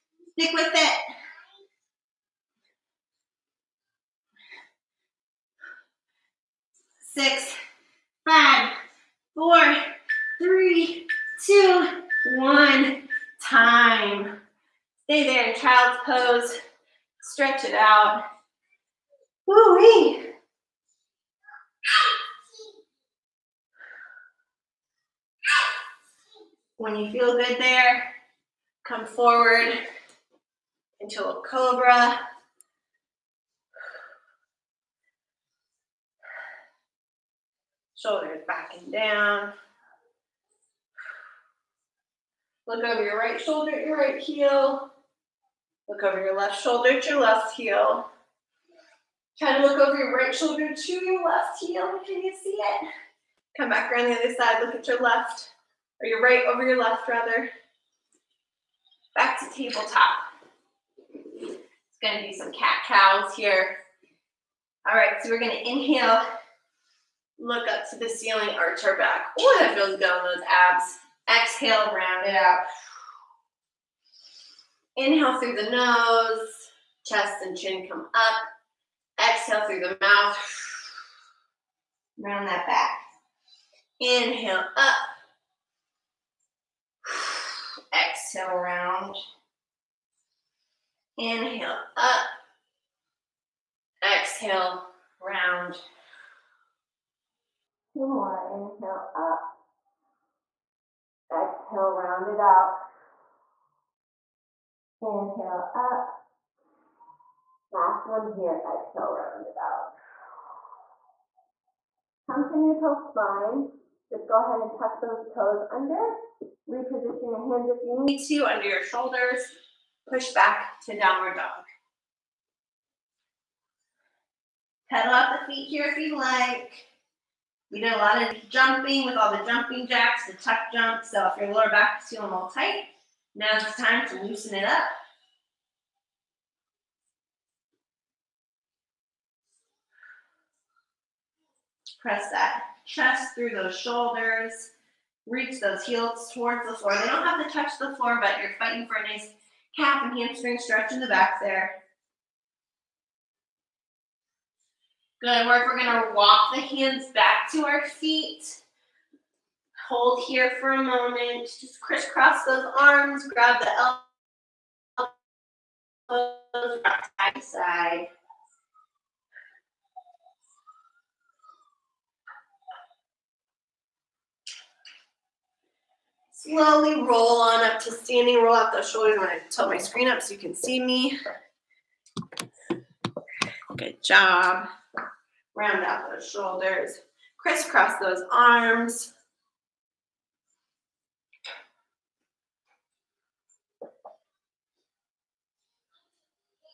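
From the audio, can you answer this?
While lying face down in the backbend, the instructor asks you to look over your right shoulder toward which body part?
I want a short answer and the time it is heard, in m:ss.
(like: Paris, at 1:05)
right heel, at 0:43.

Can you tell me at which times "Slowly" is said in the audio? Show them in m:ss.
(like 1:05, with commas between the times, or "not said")
2:56.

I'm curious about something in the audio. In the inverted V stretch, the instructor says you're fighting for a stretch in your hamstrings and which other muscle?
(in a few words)
calf.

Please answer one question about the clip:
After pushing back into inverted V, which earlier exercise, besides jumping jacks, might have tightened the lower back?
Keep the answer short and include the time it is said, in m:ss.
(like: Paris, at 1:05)
tuck jumps, at 2:10.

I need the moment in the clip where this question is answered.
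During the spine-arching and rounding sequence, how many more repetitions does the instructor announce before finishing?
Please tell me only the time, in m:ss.
1:37.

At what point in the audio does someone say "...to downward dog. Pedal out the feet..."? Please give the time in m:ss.
2:00.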